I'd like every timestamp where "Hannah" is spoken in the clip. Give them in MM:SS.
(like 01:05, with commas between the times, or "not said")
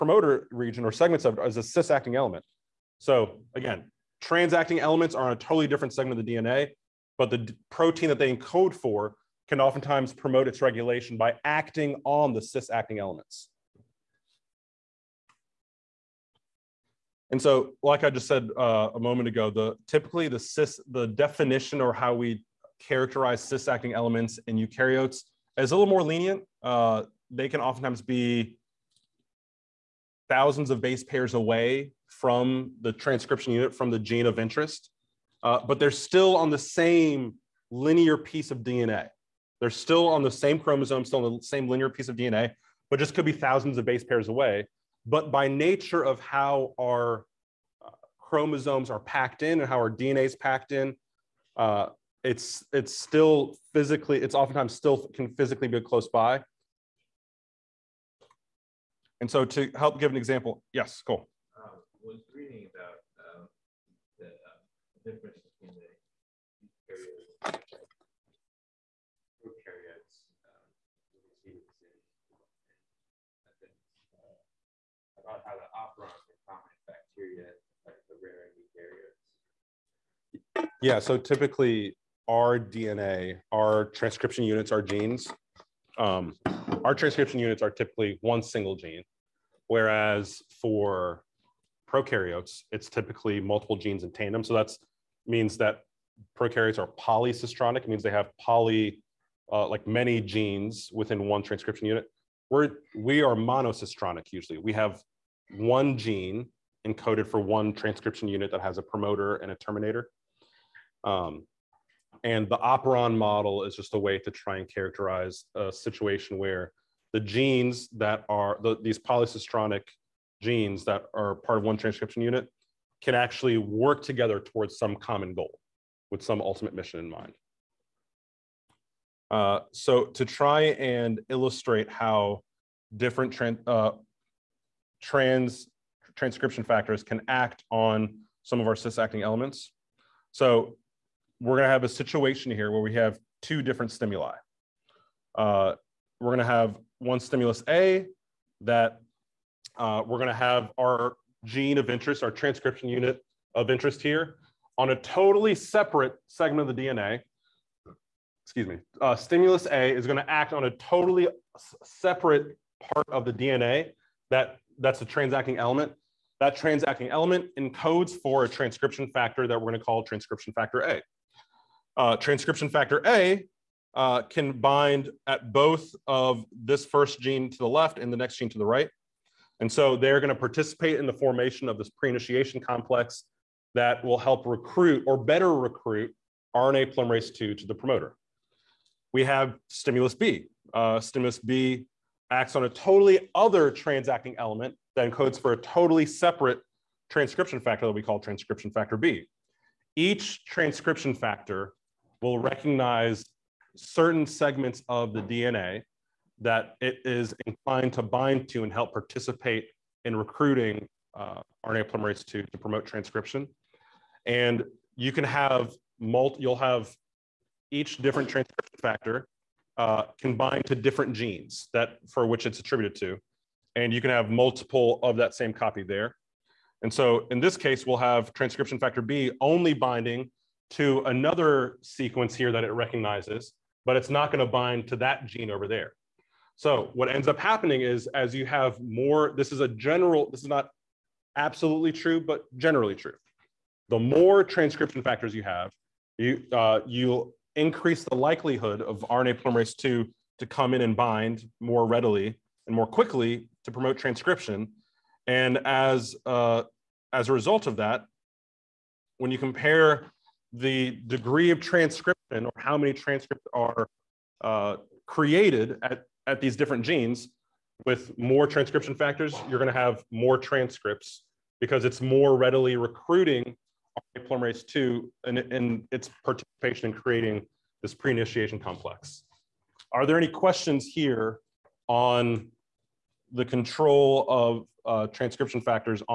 not said.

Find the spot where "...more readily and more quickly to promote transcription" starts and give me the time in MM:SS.
04:11.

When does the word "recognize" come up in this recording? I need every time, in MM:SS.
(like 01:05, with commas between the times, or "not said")
03:22, 03:52.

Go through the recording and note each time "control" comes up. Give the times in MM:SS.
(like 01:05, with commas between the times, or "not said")
04:43.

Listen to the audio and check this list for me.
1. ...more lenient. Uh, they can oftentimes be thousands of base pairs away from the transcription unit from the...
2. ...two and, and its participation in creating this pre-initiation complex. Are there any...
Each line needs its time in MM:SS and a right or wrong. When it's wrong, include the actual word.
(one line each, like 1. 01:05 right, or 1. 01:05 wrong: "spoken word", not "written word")
1. 00:25 right
2. 04:34 right.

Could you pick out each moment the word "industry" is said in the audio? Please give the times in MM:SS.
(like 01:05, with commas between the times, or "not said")
not said.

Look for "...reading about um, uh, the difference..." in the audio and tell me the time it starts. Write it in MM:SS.
01:02.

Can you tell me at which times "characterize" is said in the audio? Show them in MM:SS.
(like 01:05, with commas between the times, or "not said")
00:22, 01:54.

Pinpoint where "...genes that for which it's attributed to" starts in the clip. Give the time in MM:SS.
03:41.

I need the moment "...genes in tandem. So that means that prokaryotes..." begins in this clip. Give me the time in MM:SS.
01:33.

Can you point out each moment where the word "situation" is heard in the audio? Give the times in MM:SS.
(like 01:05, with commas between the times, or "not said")
01:55, 02:21.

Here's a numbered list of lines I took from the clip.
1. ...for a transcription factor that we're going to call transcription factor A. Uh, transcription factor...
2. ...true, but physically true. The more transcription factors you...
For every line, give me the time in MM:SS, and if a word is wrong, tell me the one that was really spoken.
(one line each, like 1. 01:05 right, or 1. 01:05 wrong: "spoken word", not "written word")
1. 02:48 right
2. 04:01 wrong: "generally", not "physically".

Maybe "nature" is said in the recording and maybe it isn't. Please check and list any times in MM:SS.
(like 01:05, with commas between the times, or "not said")
00:45.